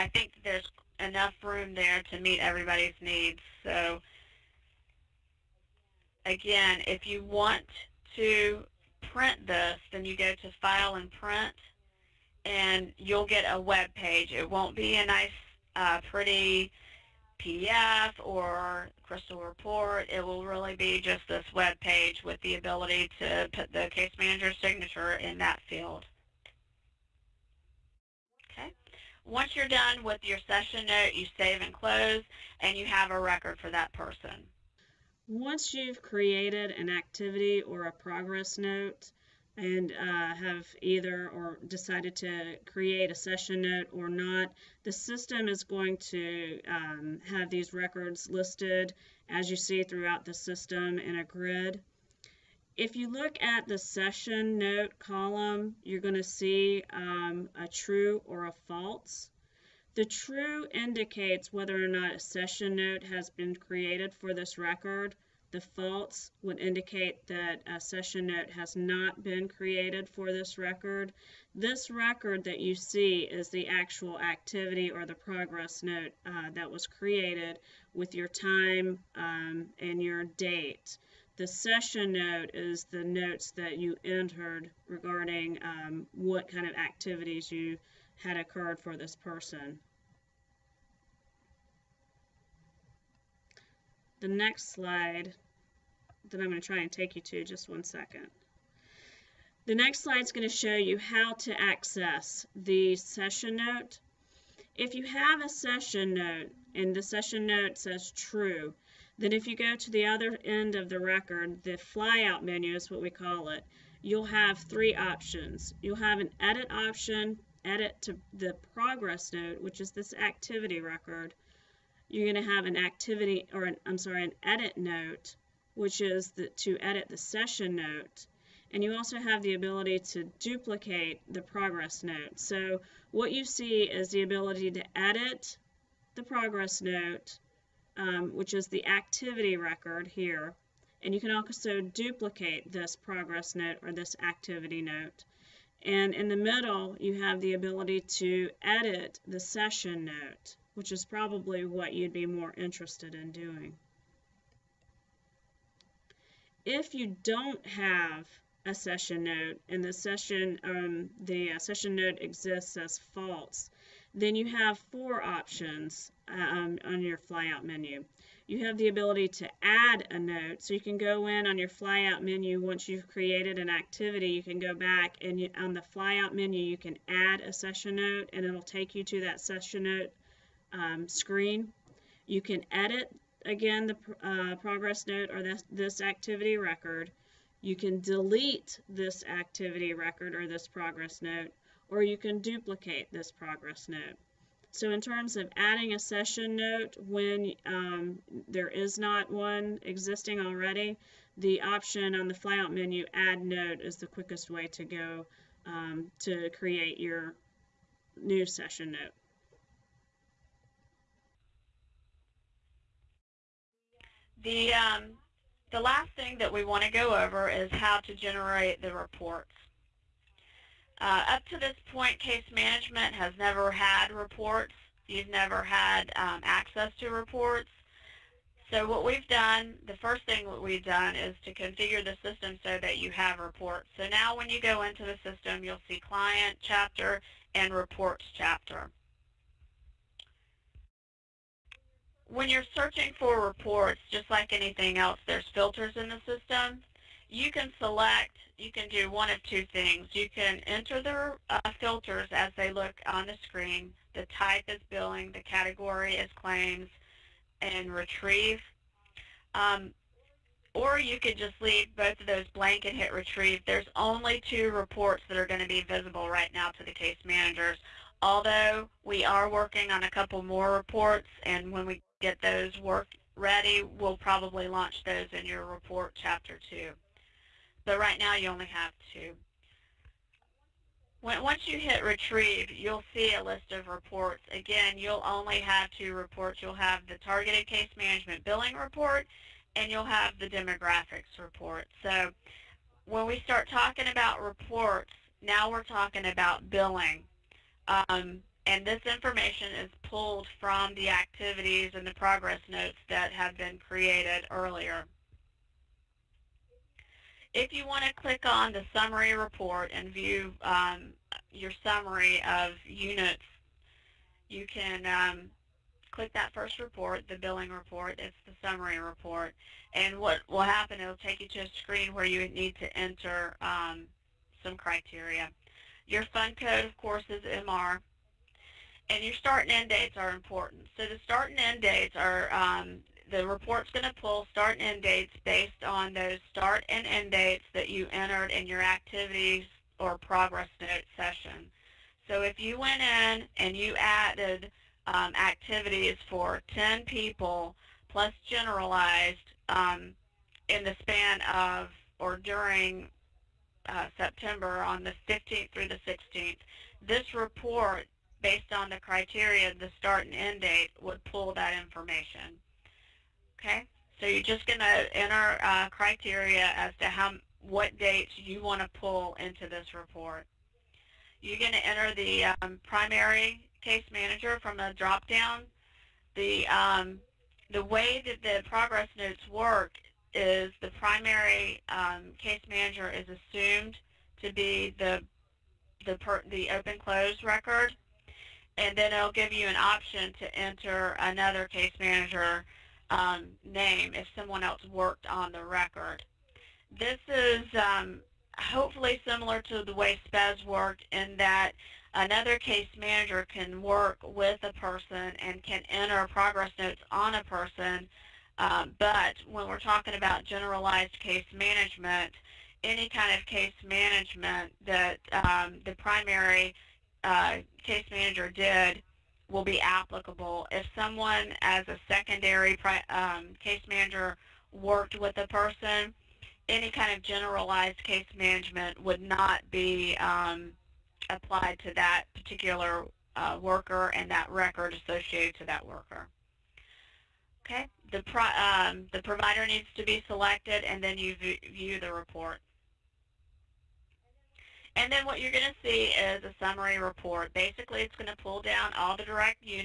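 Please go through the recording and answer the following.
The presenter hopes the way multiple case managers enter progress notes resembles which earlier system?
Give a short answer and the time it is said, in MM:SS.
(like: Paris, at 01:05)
SPES, at 06:40.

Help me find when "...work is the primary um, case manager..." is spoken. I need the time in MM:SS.
06:19.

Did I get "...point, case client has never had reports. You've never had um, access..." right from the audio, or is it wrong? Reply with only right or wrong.
wrong.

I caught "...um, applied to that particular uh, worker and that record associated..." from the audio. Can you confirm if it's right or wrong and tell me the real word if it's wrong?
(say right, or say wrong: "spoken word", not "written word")
right.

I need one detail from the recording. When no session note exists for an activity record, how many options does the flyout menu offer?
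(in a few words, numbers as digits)
4.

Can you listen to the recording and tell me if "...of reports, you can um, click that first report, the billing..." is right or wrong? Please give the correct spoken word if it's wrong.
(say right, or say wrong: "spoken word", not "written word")
wrong: "units", not "reports".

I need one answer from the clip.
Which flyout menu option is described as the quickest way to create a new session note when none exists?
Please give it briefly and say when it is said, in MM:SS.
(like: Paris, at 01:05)
add note, at 03:23.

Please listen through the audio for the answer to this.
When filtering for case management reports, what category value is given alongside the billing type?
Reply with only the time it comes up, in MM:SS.
04:15.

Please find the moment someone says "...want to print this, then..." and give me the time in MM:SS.
00:07.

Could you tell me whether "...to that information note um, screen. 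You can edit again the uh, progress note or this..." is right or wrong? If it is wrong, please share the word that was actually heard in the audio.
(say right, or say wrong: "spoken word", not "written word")
wrong: "session", not "information".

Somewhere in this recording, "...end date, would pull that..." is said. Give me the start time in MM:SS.
06:00.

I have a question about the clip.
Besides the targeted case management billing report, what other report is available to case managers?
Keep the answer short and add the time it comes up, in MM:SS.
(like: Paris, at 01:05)
demographics report, at 04:50.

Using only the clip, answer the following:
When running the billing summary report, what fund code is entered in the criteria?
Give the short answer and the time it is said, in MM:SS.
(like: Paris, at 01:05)
MR, at 05:27.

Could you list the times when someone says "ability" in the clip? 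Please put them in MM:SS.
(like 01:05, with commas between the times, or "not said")
00:22, 02:09, 02:14, 02:27, 02:48.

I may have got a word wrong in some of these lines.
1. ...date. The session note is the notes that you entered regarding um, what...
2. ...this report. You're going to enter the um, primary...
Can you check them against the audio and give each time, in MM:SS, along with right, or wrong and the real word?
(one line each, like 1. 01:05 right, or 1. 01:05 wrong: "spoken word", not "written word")
1. 01:20 right
2. 06:09 right.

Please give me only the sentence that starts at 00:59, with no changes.
The true indicates whether or not a session note has been created for this record.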